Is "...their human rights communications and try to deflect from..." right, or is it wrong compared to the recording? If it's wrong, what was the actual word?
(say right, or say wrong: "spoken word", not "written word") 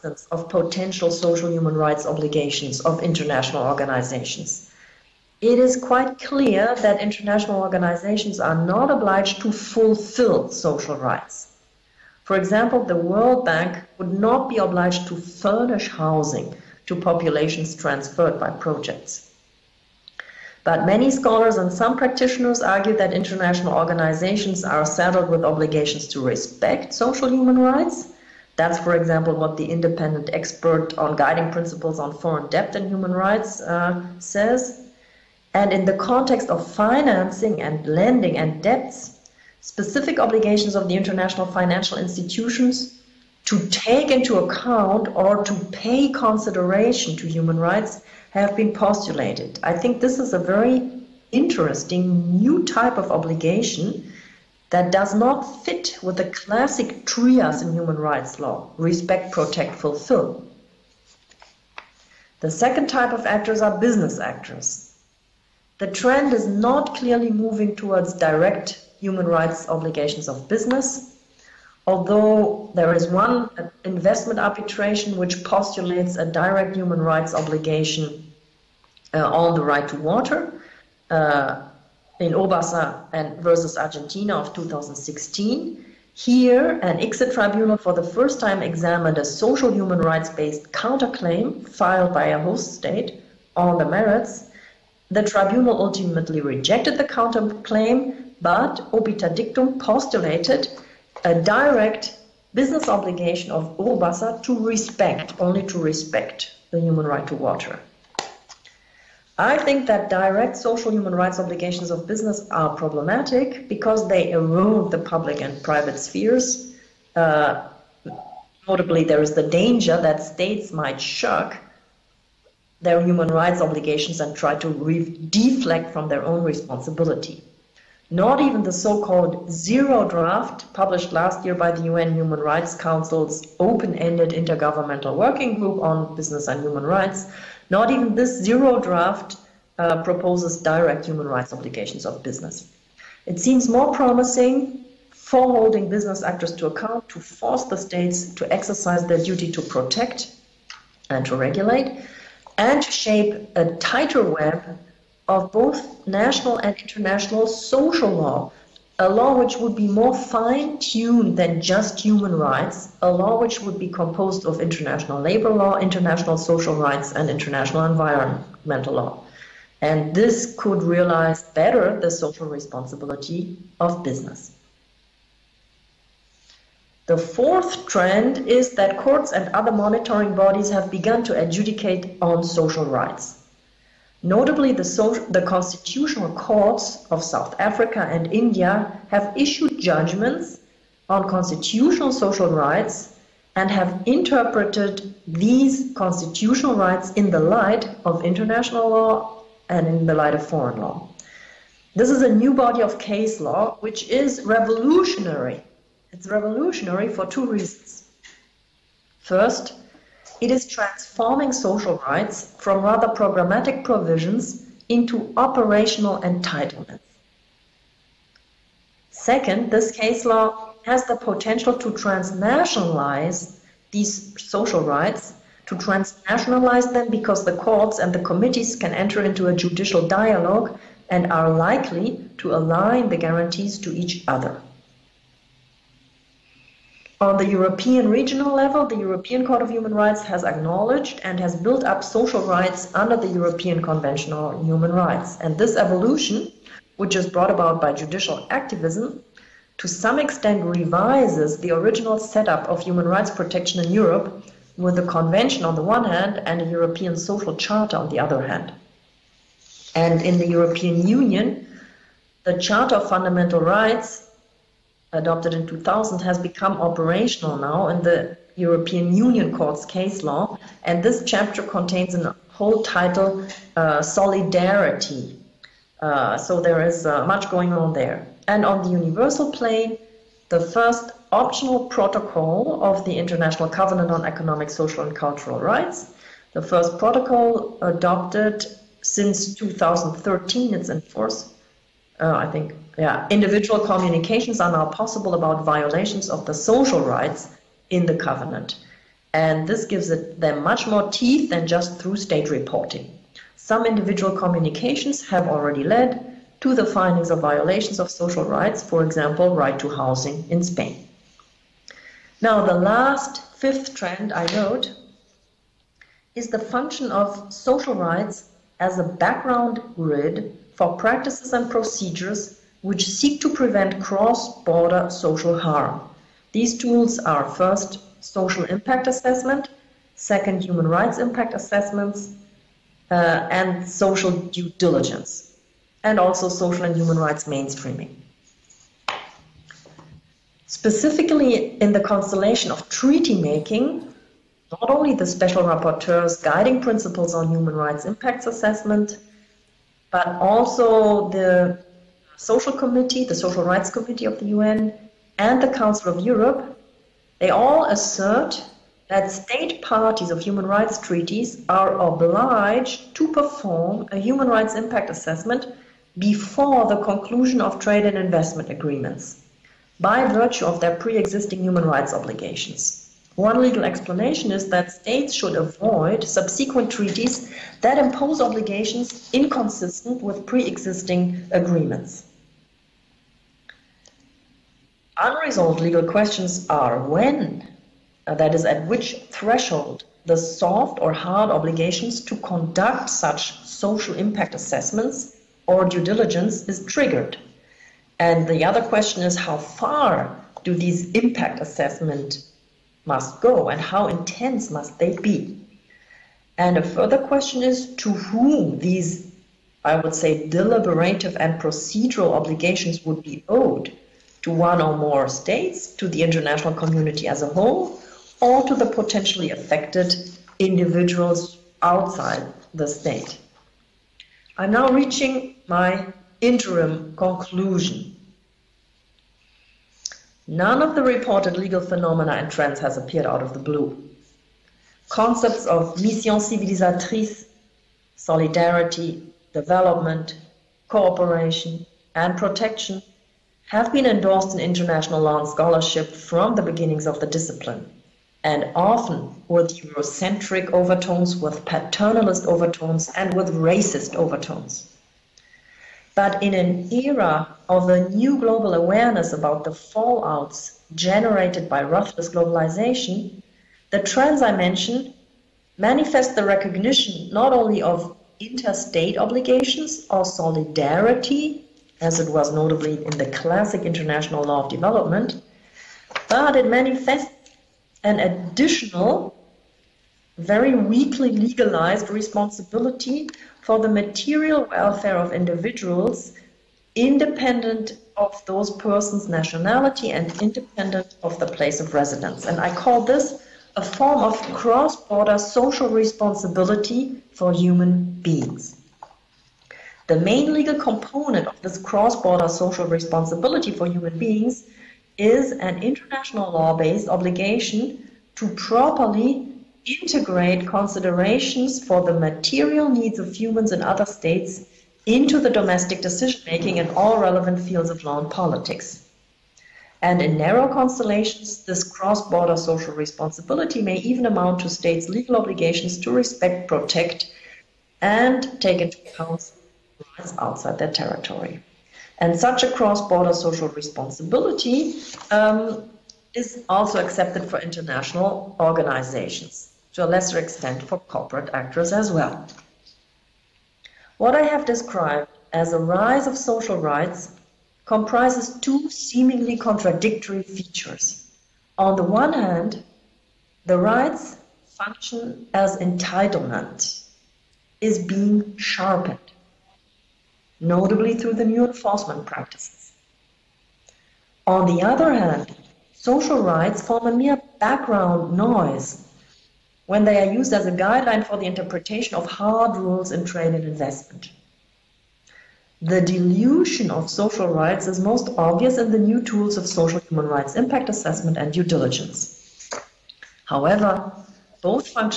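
wrong: "obligations", not "communications".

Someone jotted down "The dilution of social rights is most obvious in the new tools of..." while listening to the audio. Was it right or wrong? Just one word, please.
right.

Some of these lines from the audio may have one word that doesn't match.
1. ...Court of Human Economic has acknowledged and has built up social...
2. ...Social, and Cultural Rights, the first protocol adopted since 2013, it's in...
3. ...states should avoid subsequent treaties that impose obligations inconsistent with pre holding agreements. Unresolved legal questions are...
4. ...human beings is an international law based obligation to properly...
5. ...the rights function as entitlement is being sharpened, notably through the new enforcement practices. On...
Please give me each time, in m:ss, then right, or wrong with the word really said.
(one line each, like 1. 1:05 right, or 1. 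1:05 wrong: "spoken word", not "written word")
1. 3:59 wrong: "Rights", not "Economic"
2. 4:44 right
3. 6:14 wrong: "existing", not "holding"
4. 8:23 right
5. 9:13 right.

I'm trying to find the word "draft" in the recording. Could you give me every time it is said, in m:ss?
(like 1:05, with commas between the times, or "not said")
2:10, 2:18.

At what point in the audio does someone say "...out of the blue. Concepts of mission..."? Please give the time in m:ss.
7:13.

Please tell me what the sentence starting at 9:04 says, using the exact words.
What I have described as a rise of social rights comprises two seemingly contradictory features.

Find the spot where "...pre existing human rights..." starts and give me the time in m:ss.
6:10.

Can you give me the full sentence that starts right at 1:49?
I think that direct social human rights obligations of business are problematic because they erode the public and private spheres.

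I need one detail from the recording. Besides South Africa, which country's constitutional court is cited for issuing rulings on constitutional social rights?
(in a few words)
India.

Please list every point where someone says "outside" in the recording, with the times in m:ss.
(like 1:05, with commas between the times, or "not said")
7:01, 8:50.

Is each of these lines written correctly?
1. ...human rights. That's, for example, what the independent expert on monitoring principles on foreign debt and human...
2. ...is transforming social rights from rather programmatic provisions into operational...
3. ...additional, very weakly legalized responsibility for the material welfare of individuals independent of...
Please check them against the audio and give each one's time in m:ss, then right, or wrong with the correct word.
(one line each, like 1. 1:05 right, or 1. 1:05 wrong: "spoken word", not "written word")
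1. 0:27 wrong: "guiding", not "monitoring"
2. 3:30 right
3. 7:58 right.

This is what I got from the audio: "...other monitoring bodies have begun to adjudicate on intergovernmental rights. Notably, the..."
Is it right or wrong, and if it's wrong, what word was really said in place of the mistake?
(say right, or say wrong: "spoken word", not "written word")
wrong: "social", not "intergovernmental".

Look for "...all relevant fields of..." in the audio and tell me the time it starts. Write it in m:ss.
8:36.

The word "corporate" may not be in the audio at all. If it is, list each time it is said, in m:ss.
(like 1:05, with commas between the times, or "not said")
9:00.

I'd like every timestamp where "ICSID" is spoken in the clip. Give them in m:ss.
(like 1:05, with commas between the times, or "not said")
1:26.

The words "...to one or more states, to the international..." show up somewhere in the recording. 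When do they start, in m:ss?
6:54.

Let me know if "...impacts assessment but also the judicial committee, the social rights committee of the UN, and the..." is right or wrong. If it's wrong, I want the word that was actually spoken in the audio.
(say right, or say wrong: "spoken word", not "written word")
wrong: "social", not "judicial".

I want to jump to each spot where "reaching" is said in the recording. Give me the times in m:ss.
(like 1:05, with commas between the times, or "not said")
7:04.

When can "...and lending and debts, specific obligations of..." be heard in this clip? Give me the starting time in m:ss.
0:37.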